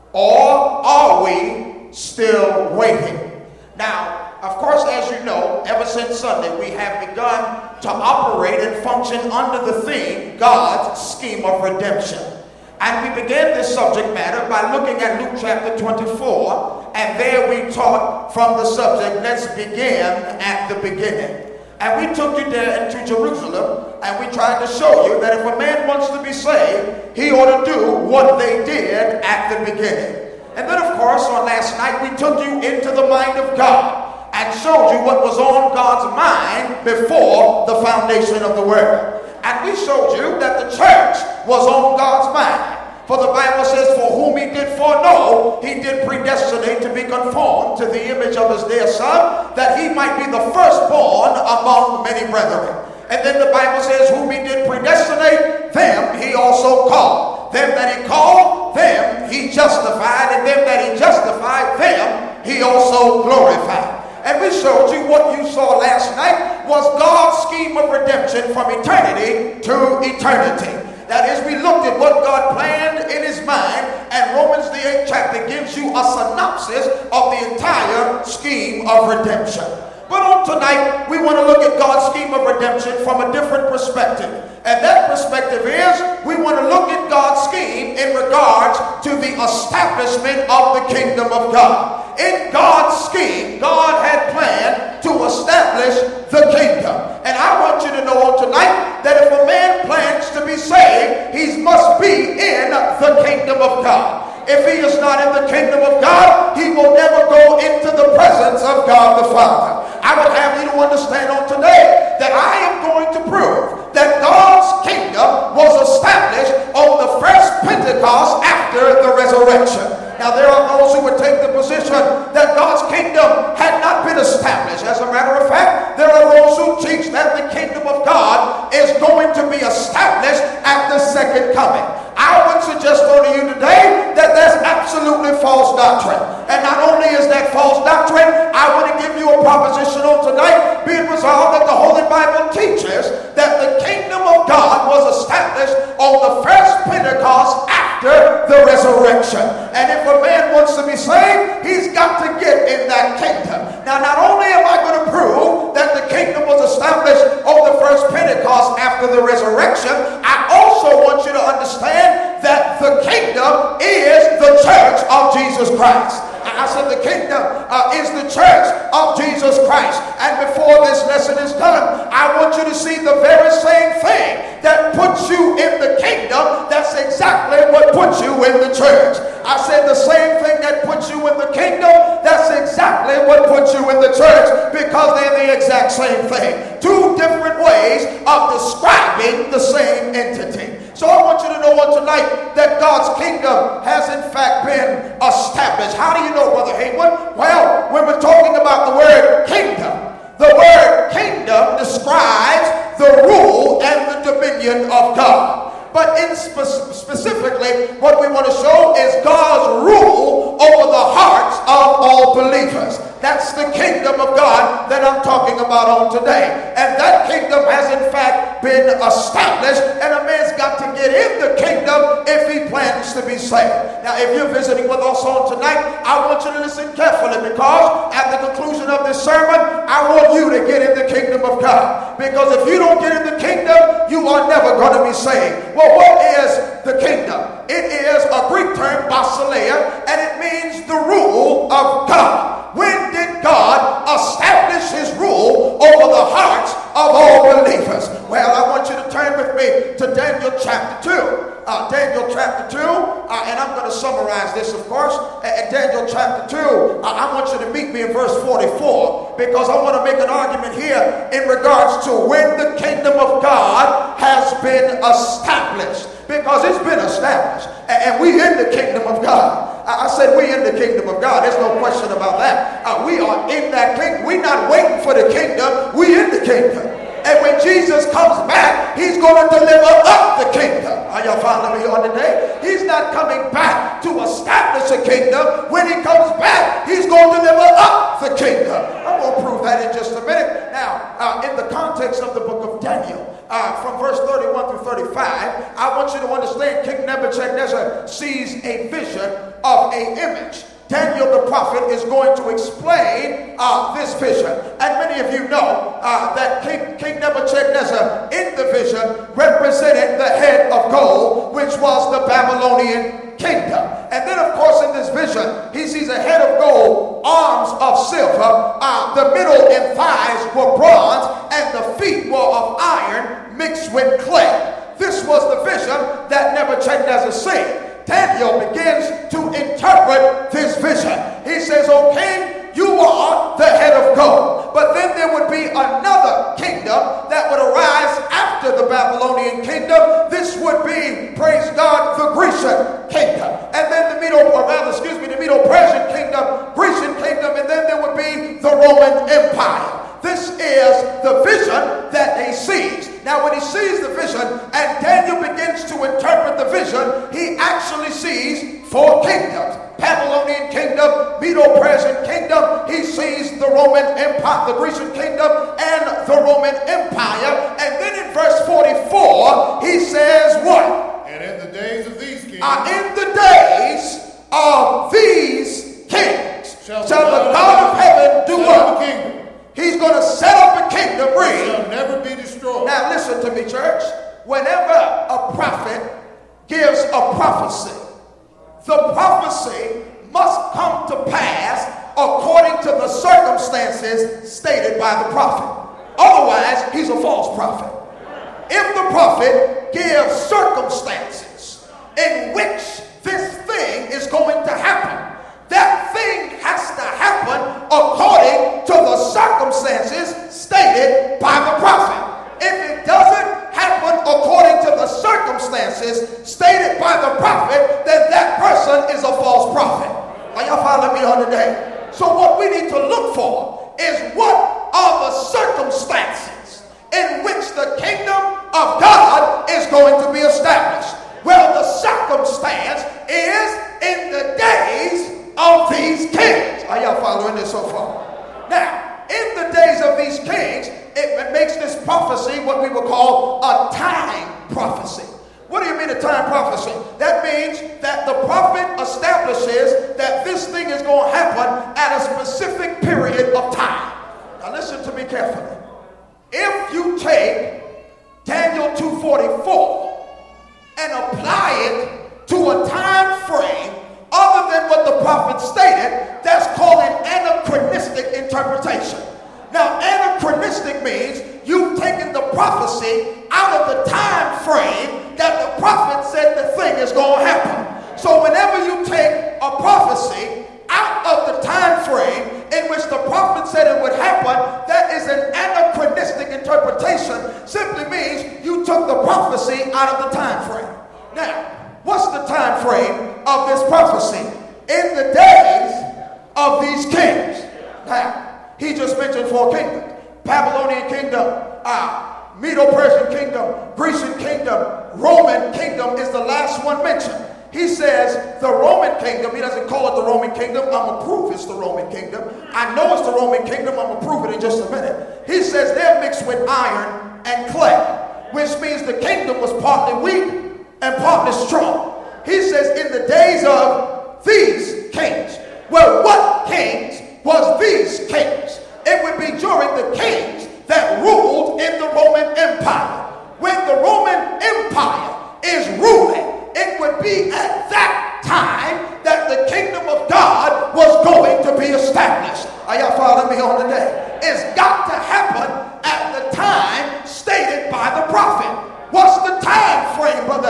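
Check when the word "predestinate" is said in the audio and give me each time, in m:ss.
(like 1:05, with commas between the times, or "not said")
0:46, 0:54.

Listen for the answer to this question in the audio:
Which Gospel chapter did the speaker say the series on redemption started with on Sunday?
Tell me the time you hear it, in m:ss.
0:15.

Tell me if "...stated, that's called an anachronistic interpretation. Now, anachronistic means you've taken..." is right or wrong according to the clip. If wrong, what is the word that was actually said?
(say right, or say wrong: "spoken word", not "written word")
right.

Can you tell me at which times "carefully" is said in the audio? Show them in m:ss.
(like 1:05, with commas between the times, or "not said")
3:46, 7:35.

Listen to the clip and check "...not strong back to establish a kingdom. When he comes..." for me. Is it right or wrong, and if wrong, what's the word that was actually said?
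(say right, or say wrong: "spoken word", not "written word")
wrong: "coming", not "strong".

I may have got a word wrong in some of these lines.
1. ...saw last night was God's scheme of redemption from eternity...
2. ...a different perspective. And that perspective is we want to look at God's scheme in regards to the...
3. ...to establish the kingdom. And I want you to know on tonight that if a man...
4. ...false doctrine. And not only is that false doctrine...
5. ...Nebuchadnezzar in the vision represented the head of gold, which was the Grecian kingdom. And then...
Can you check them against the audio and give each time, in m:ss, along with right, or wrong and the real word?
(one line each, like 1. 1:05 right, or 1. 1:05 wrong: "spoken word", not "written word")
1. 1:05 right
2. 1:23 right
3. 1:35 right
4. 2:15 right
5. 5:07 wrong: "Babylonian", not "Grecian".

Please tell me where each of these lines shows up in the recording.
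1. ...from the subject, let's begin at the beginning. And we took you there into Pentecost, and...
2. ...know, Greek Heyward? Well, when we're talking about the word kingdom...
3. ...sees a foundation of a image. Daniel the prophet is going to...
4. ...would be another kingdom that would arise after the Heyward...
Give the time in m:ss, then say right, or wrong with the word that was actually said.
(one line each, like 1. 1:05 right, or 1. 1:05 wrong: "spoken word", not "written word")
1. 0:18 wrong: "Jerusalem", not "Pentecost"
2. 3:16 wrong: "Brother", not "Greek"
3. 4:58 wrong: "vision", not "foundation"
4. 5:35 wrong: "Babylonian", not "Heyward".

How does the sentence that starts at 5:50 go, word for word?
This is the vision now, when he sees the vision and Daniel begins to interpret the vision, he actually sees four kingdoms.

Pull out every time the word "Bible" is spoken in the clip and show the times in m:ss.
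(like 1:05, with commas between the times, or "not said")
0:43, 0:53, 2:22.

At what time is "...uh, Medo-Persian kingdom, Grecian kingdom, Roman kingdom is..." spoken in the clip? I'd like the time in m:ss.
8:22.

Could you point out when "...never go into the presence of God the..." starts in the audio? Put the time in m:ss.
1:46.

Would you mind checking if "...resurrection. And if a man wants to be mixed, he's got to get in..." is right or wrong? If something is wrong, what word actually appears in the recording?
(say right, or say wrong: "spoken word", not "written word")
wrong: "saved", not "mixed".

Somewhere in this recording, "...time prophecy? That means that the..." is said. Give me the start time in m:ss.
7:26.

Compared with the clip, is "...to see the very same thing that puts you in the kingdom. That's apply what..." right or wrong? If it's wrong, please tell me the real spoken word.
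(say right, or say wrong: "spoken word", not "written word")
wrong: "exactly", not "apply".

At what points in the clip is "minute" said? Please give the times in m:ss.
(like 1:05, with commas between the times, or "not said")
4:50, 8:34.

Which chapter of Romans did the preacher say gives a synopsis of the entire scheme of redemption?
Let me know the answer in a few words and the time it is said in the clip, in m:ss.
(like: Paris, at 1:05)
8th, at 1:14.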